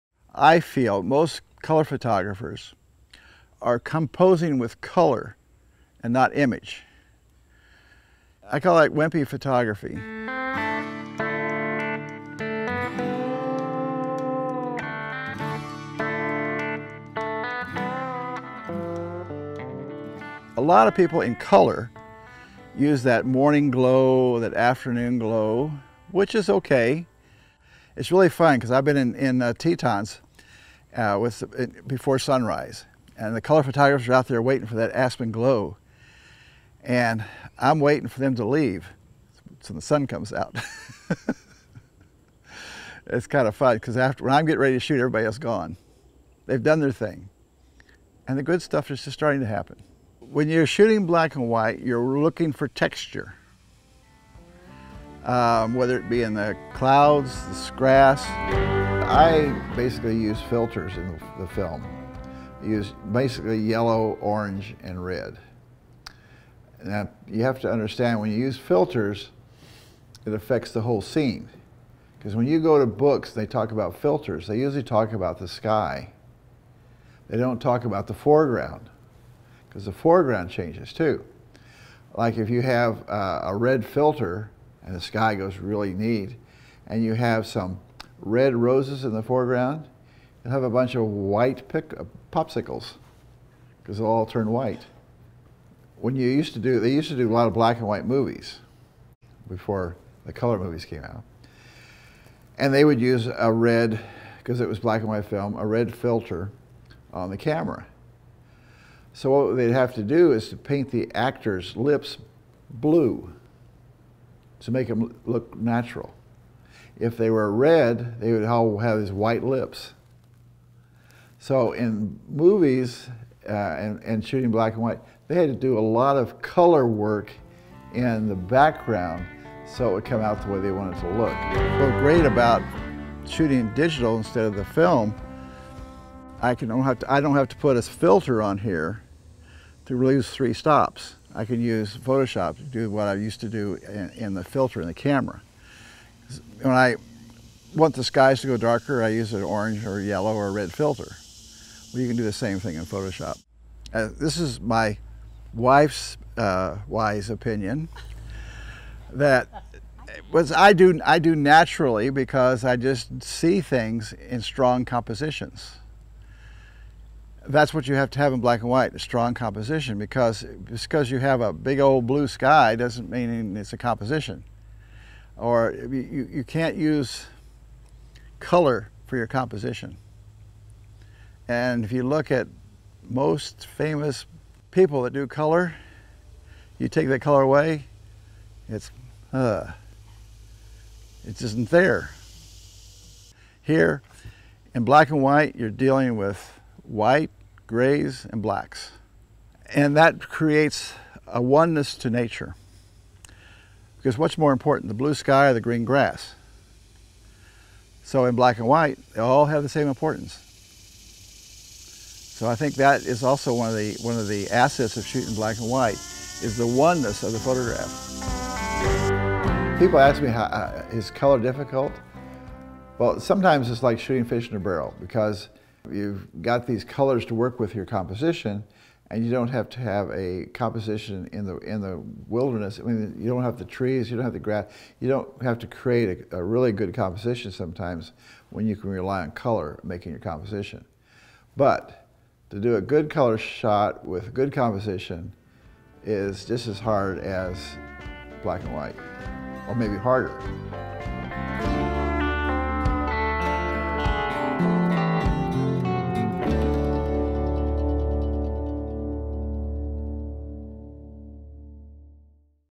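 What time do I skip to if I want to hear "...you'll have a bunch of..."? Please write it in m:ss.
1:30.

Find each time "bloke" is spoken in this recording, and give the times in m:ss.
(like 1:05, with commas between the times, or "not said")
not said.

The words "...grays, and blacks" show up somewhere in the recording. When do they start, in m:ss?
3:17.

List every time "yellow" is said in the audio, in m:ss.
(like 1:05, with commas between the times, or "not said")
1:03, 2:30.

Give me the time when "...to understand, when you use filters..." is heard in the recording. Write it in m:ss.
1:07.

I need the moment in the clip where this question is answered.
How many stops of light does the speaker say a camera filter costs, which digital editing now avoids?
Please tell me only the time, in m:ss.
2:20.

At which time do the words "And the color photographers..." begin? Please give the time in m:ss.
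0:33.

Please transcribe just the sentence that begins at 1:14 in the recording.
They usually talk about the sky.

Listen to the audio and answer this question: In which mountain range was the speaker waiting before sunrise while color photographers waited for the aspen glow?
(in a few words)
Tetons.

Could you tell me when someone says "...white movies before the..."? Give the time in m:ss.
1:37.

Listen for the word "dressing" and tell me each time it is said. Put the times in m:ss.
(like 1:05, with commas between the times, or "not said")
not said.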